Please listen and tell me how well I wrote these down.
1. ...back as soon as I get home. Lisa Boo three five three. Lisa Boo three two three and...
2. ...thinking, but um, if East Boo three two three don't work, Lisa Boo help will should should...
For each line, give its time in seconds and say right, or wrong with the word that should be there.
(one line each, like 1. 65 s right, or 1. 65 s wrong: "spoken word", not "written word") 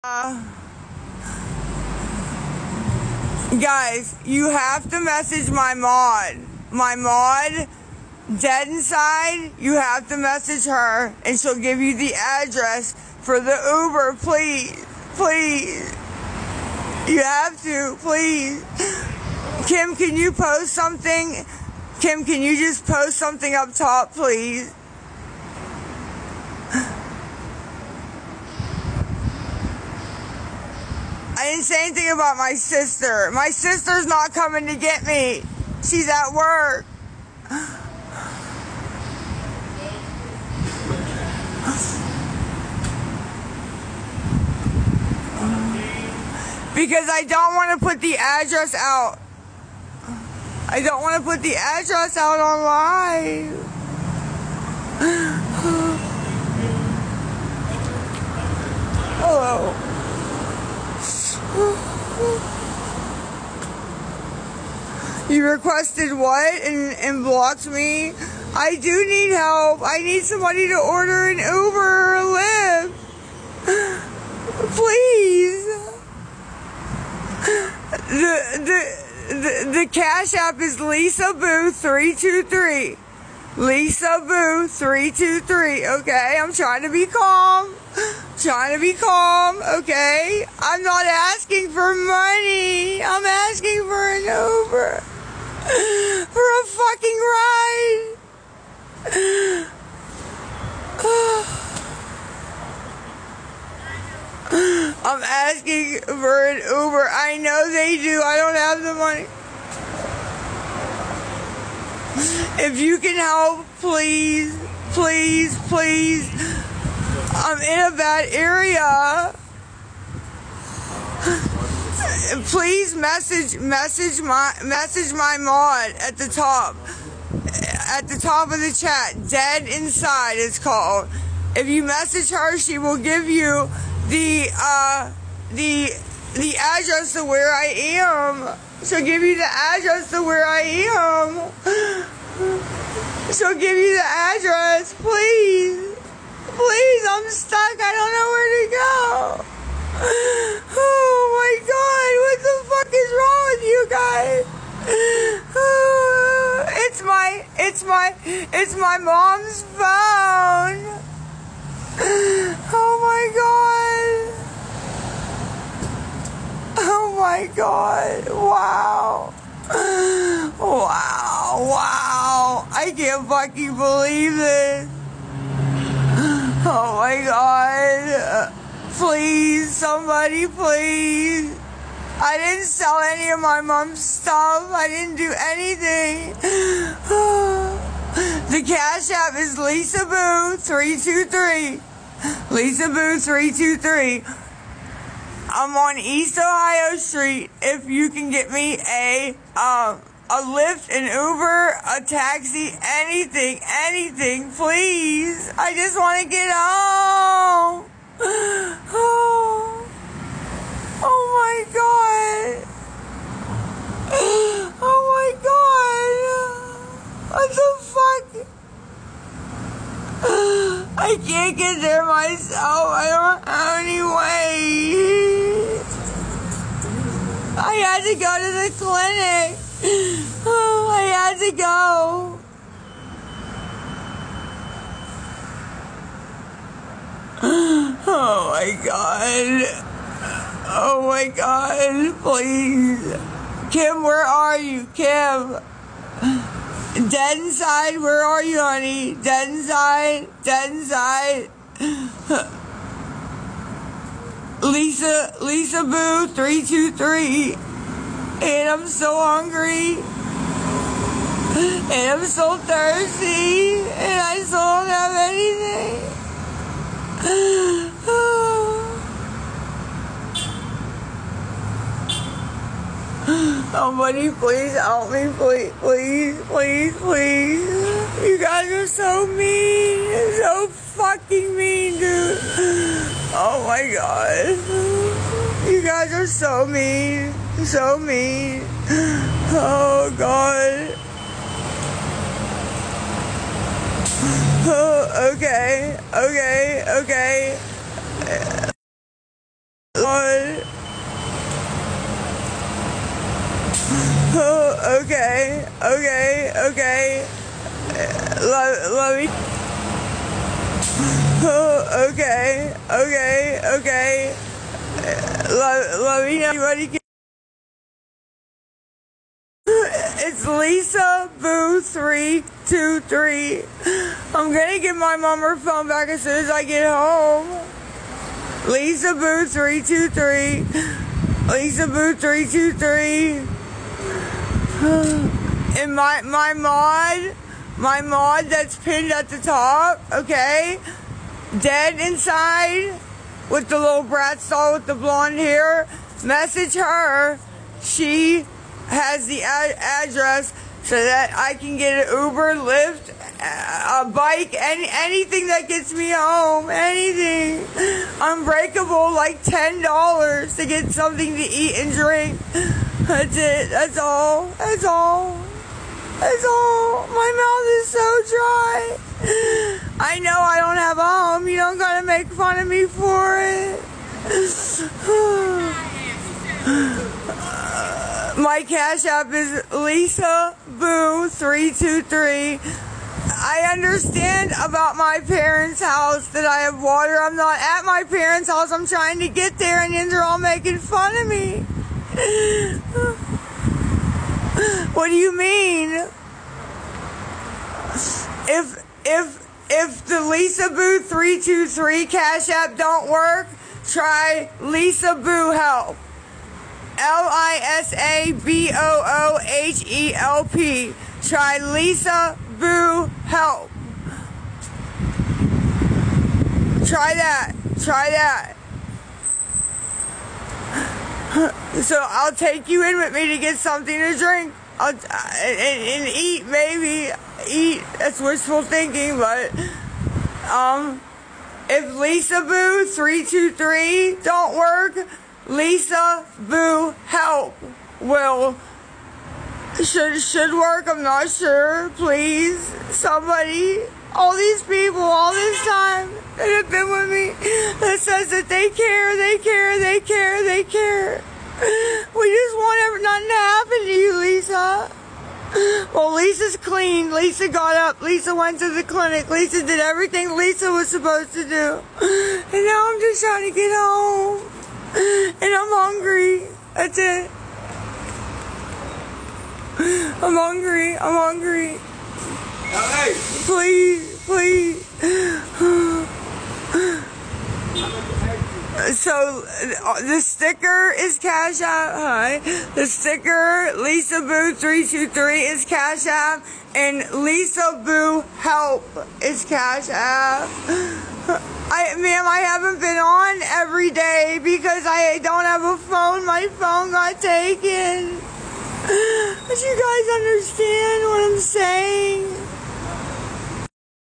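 1. 325 s wrong: "two", not "five"
2. 428 s wrong: "Lisa", not "East".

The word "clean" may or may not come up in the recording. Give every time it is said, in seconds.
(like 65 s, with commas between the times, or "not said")
456 s.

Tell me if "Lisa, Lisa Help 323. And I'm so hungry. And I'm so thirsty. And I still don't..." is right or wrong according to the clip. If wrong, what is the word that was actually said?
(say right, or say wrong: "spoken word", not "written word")
wrong: "Boo", not "Help".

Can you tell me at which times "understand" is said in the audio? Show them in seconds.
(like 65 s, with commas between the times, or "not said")
383 s, 500 s.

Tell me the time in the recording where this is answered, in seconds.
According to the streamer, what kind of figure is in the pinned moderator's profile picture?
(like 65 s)
343 s.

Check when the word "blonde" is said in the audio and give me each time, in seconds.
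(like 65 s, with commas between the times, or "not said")
344 s.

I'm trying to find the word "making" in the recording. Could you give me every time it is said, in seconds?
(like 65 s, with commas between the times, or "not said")
390 s.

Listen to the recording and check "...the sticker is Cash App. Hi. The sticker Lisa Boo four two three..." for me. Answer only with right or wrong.
wrong.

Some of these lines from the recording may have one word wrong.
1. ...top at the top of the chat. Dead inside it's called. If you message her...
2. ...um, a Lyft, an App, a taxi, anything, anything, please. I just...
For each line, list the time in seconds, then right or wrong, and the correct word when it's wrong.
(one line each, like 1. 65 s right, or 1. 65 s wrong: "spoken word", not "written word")
1. 126 s right
2. 199 s wrong: "Uber", not "App".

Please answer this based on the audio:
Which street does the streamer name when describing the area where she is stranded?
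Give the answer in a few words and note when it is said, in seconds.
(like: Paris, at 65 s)
East Ohio Street, at 195 s.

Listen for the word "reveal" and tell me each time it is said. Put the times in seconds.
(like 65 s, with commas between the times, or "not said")
not said.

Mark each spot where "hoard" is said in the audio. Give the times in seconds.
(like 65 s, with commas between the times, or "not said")
not said.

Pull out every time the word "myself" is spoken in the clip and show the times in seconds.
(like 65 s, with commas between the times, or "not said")
222 s.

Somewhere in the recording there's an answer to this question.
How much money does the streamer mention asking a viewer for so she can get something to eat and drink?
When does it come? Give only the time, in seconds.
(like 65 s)
359 s.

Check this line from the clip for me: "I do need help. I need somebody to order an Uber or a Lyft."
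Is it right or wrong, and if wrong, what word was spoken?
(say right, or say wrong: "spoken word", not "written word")
right.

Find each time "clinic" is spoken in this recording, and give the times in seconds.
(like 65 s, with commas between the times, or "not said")
228 s, 458 s.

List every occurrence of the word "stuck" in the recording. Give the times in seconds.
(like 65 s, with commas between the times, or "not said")
147 s.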